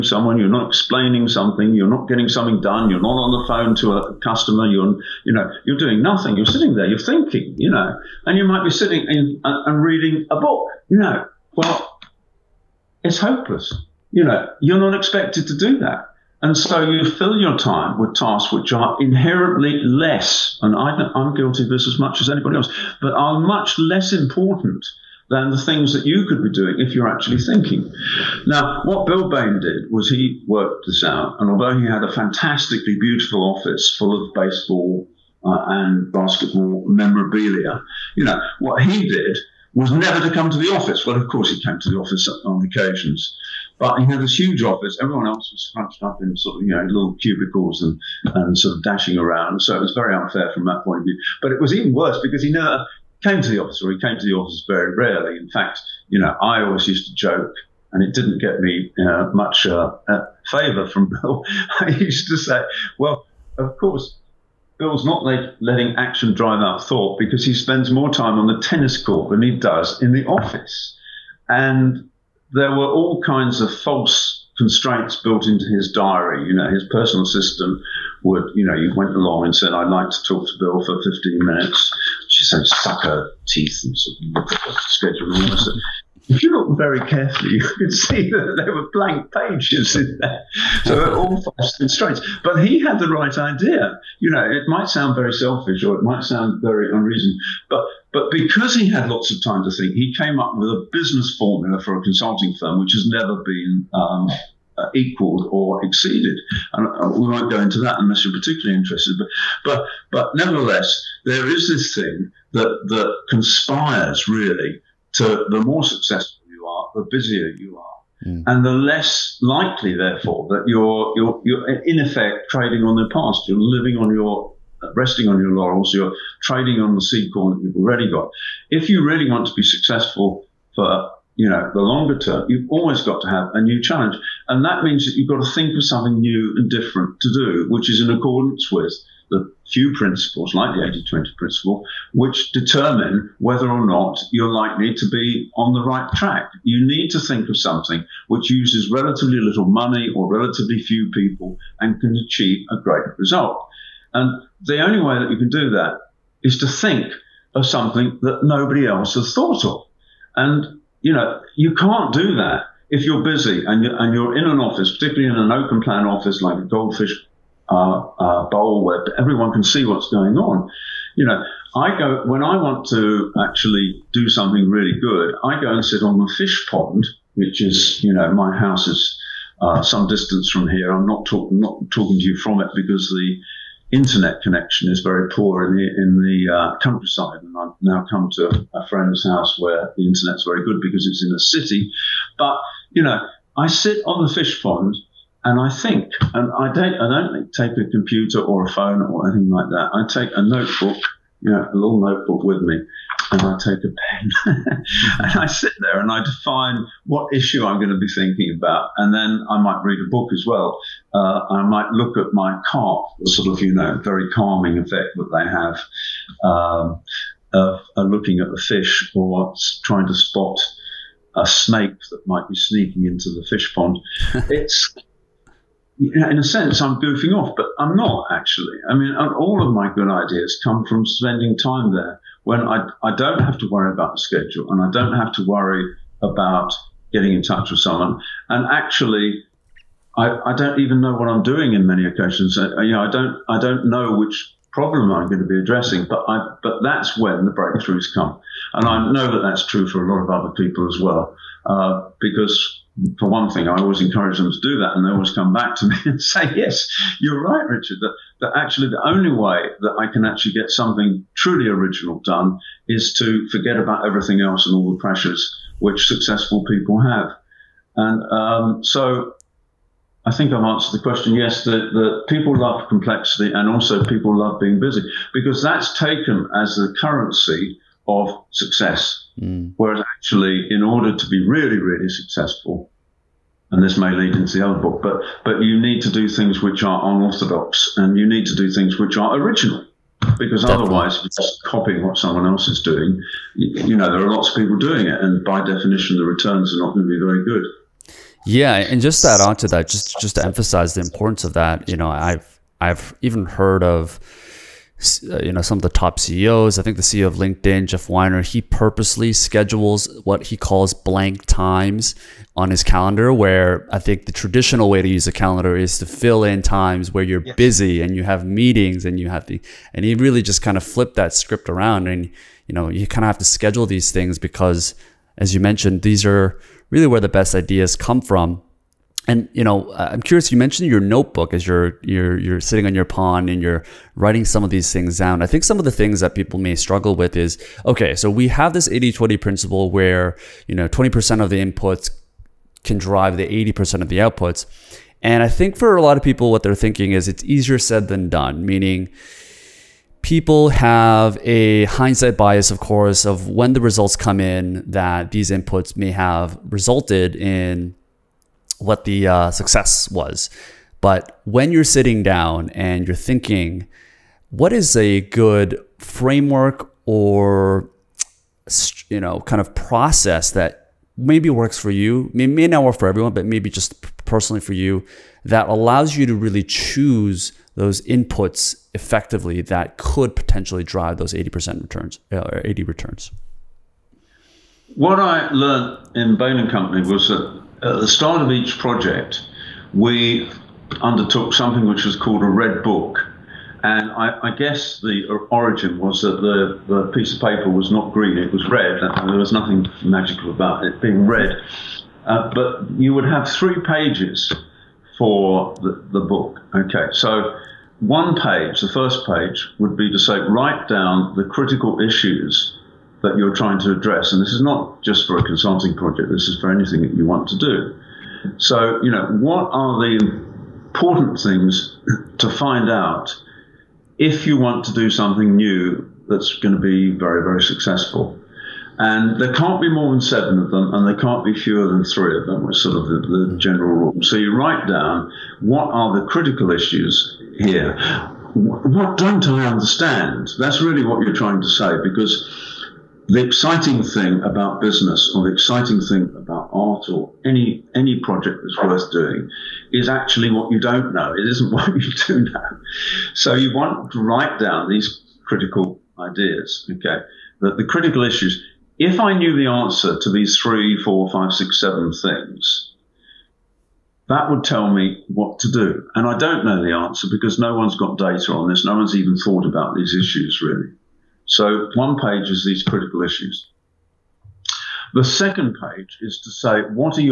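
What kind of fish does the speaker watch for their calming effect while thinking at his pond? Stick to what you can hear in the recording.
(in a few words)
Carp.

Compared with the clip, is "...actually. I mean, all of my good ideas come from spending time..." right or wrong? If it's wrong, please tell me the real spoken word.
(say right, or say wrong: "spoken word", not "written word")
right.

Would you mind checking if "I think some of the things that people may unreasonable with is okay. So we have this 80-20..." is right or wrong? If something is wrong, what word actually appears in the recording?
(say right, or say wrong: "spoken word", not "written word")
wrong: "struggle", not "unreasonable".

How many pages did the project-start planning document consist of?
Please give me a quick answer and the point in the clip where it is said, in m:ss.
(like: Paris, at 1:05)
3, at 6:43.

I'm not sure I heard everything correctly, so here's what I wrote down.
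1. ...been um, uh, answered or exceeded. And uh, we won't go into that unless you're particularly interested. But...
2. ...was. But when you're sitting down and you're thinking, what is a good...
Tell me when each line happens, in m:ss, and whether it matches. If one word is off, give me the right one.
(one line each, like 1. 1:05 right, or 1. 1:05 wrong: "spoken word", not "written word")
1. 1:43 wrong: "equaled", not "answered"
2. 6:00 right.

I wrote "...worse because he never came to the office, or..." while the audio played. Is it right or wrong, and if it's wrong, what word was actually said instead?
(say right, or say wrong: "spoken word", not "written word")
right.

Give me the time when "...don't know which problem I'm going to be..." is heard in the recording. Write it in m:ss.
4:03.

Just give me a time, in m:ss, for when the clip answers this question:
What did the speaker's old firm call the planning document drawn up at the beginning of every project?
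6:32.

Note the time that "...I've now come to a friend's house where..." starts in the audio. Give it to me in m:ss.
3:07.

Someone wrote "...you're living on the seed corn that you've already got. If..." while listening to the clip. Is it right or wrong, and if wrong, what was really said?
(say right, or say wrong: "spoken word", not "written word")
wrong: "trading", not "living".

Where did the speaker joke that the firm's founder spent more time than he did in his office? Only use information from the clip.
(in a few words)
The tennis court.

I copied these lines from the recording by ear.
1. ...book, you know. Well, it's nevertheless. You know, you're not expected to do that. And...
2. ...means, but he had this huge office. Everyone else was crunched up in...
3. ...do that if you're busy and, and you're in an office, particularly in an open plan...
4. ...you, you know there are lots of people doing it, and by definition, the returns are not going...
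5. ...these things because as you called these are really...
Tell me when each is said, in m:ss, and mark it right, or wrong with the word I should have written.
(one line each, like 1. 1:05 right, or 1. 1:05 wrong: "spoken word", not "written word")
1. 0:10 wrong: "hopeless", not "nevertheless"
2. 0:42 wrong: "occasions", not "means"
3. 2:42 right
4. 4:53 right
5. 5:23 wrong: "mentioned", not "called".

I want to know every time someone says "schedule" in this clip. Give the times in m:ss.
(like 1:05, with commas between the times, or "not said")
1:24, 3:54, 5:09, 5:23.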